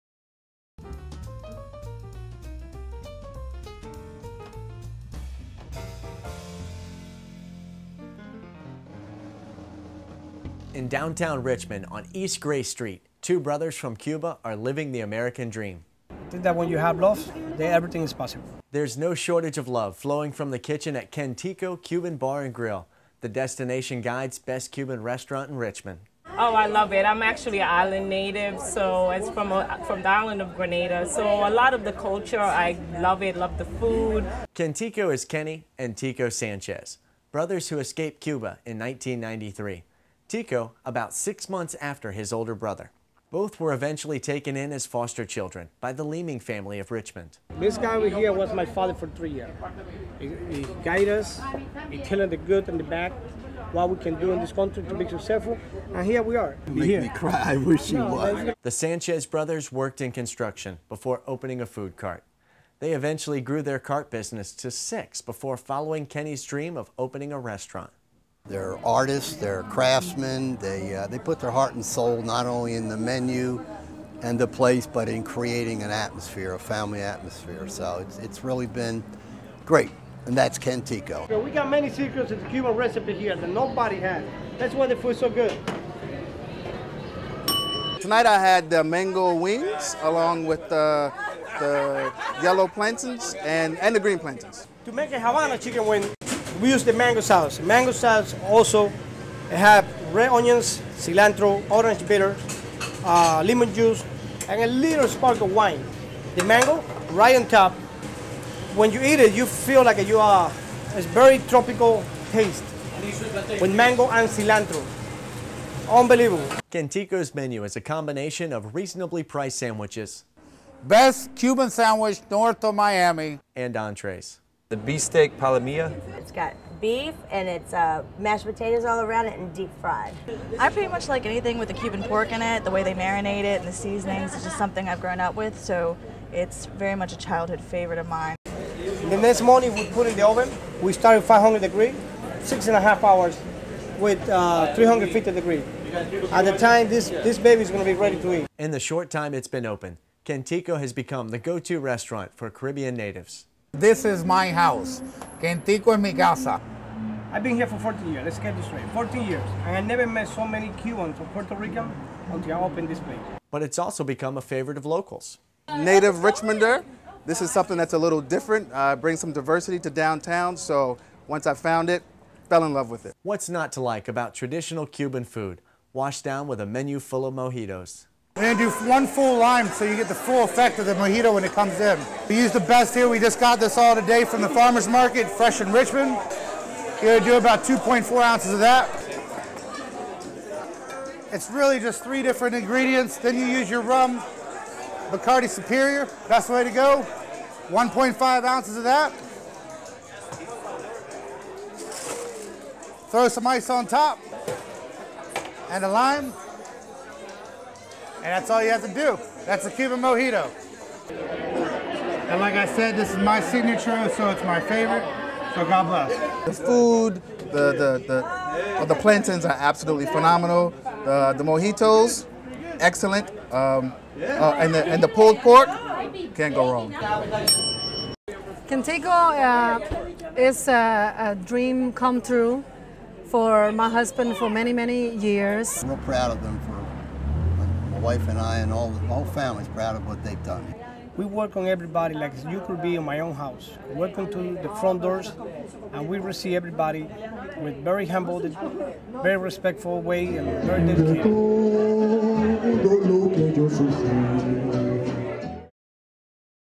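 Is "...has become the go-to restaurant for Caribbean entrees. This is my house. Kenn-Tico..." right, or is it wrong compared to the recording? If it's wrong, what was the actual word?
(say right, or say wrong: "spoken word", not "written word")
wrong: "natives", not "entrees".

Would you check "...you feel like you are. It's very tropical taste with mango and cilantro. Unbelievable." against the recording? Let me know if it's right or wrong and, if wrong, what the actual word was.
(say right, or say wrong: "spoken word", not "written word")
right.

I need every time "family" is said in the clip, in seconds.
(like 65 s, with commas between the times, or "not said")
46 s, 76 s.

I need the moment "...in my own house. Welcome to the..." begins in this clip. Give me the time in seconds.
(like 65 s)
242 s.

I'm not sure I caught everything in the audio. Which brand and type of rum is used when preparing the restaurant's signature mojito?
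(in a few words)
Bacardi Superior.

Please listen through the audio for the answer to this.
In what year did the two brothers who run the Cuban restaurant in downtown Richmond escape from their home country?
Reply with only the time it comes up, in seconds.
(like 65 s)
38 s.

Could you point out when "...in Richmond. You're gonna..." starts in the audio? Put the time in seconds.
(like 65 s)
185 s.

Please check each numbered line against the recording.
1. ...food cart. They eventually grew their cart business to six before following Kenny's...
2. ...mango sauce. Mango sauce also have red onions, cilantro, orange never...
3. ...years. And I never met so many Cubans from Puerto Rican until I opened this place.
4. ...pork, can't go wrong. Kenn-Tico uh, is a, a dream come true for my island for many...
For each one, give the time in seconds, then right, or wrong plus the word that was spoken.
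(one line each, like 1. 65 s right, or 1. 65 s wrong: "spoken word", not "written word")
1. 61 s right
2. 96 s wrong: "bitter", not "never"
3. 159 s right
4. 225 s wrong: "husband", not "island".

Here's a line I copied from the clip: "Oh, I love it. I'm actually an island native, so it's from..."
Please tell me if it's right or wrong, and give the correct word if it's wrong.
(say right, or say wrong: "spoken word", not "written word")
right.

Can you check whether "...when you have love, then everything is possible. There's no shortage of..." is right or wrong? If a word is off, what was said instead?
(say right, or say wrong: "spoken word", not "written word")
right.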